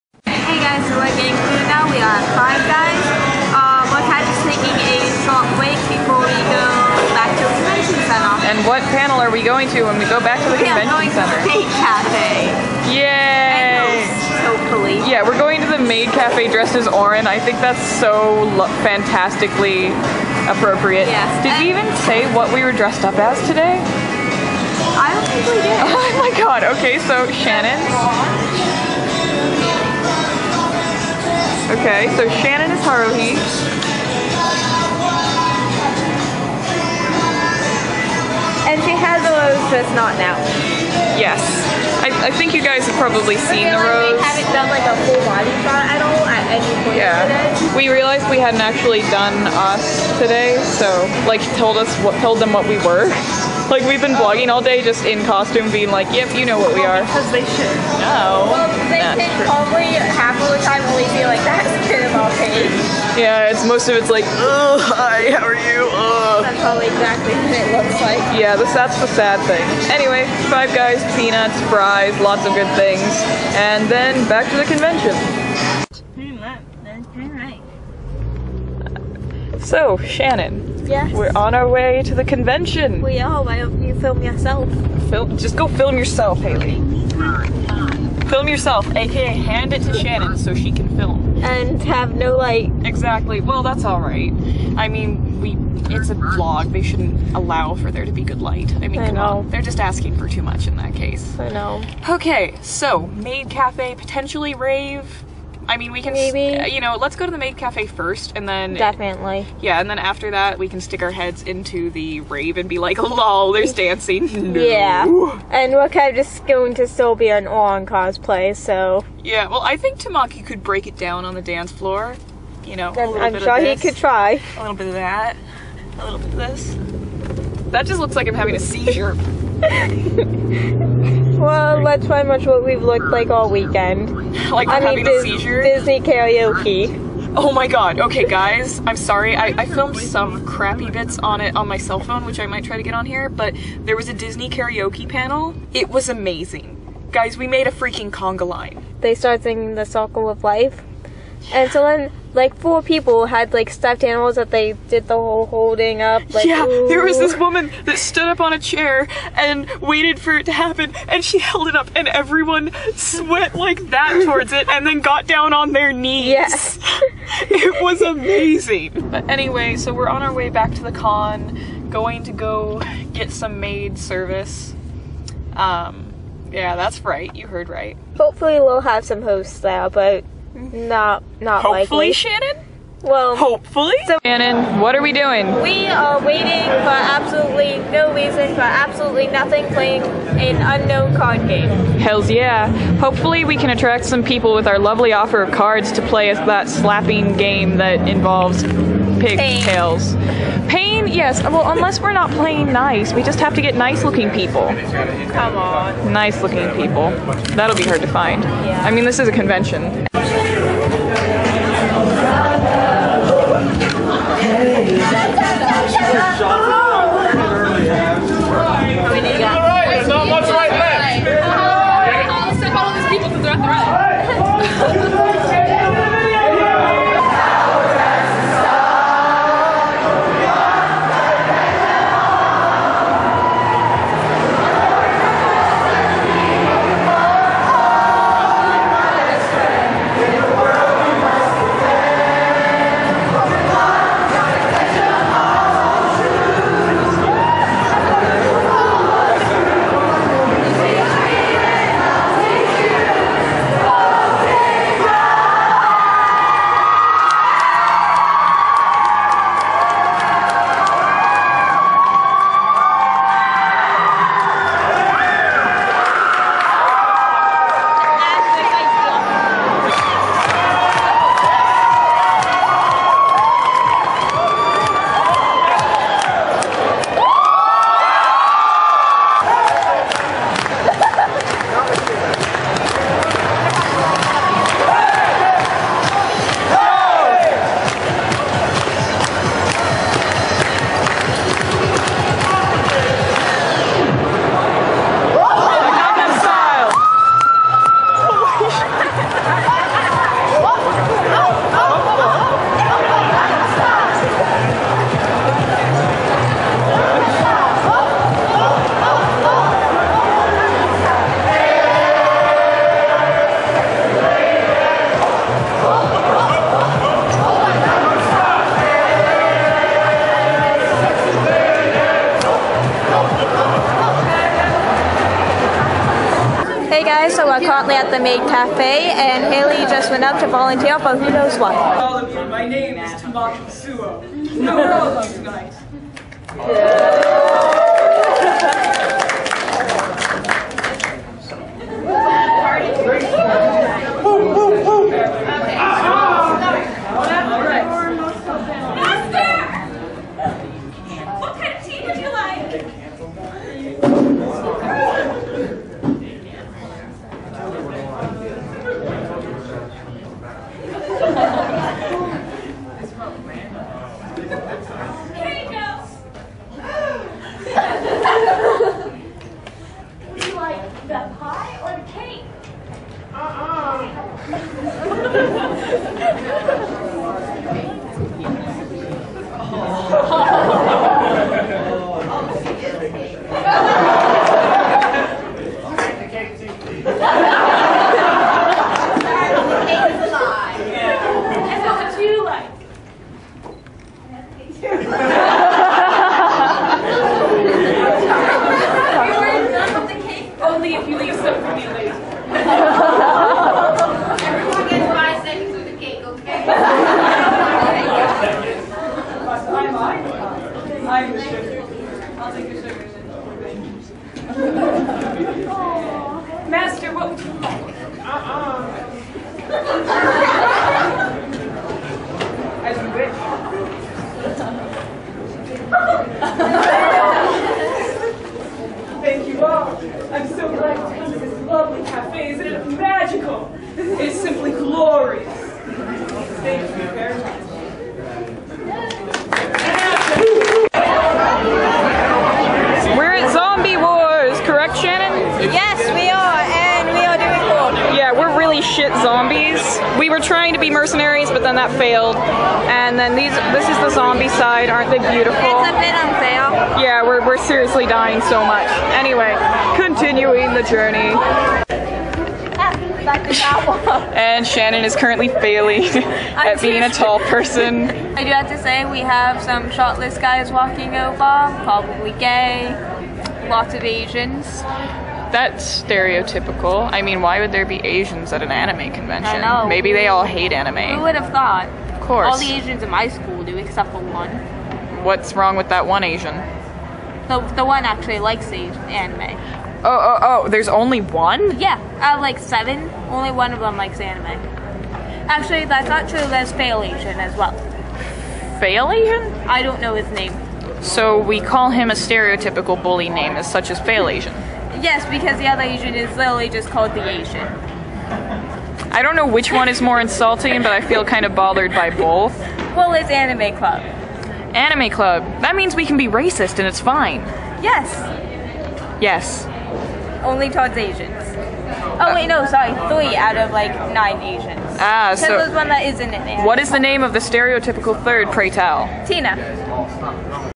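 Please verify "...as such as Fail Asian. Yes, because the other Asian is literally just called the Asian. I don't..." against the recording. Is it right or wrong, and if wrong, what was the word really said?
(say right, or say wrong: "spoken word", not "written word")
right.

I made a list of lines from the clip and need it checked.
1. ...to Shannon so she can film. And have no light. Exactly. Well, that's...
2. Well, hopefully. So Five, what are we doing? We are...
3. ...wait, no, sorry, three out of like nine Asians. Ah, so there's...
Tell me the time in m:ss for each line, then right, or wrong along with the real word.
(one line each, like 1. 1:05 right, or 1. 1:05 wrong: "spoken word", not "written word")
1. 1:29 right
2. 3:03 wrong: "Shannon", not "Five"
3. 8:42 right.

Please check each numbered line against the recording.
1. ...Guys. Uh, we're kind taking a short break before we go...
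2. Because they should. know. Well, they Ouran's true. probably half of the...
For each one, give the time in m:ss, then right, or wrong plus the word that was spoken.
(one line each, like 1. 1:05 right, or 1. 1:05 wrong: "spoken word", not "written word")
1. 0:02 right
2. 0:57 wrong: "That", not "Ouran".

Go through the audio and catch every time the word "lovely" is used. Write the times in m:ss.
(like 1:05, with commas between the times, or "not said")
3:14.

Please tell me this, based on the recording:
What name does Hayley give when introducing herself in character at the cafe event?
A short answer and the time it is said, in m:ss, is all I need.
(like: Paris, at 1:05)
Tamaki Suo, at 5:33.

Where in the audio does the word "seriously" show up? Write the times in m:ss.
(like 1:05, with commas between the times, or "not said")
7:37.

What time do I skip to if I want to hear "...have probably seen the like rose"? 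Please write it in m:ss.
0:42.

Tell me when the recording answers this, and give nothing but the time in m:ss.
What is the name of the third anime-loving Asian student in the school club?
8:49.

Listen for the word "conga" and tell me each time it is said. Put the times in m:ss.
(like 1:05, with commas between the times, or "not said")
2:28.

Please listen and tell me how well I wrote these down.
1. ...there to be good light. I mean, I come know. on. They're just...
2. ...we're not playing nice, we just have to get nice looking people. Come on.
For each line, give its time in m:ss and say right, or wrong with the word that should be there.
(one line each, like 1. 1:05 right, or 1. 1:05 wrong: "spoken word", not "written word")
1. 1:37 right
2. 3:21 right.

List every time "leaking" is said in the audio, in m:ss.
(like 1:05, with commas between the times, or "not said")
not said.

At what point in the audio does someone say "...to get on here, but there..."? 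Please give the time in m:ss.
2:22.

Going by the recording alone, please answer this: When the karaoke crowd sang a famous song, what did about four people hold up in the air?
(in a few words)
Stuffed animals.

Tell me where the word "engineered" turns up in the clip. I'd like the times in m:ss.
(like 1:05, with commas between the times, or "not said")
not said.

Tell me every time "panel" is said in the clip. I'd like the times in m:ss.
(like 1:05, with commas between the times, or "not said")
0:08, 2:25.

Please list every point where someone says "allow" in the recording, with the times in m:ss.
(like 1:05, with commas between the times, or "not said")
1:37.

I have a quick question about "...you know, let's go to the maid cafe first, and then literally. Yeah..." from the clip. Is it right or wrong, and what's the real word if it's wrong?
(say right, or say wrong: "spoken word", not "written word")
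wrong: "definitely", not "literally".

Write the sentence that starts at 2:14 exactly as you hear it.
Like I having mean, a Dis- seizure.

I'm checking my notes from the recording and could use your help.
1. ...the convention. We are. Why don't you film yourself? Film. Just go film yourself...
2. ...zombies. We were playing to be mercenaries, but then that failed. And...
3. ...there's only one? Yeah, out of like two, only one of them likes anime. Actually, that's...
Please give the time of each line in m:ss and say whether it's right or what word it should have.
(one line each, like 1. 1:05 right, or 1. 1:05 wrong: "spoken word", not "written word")
1. 1:22 right
2. 7:29 wrong: "trying", not "playing"
3. 8:10 wrong: "seven", not "two".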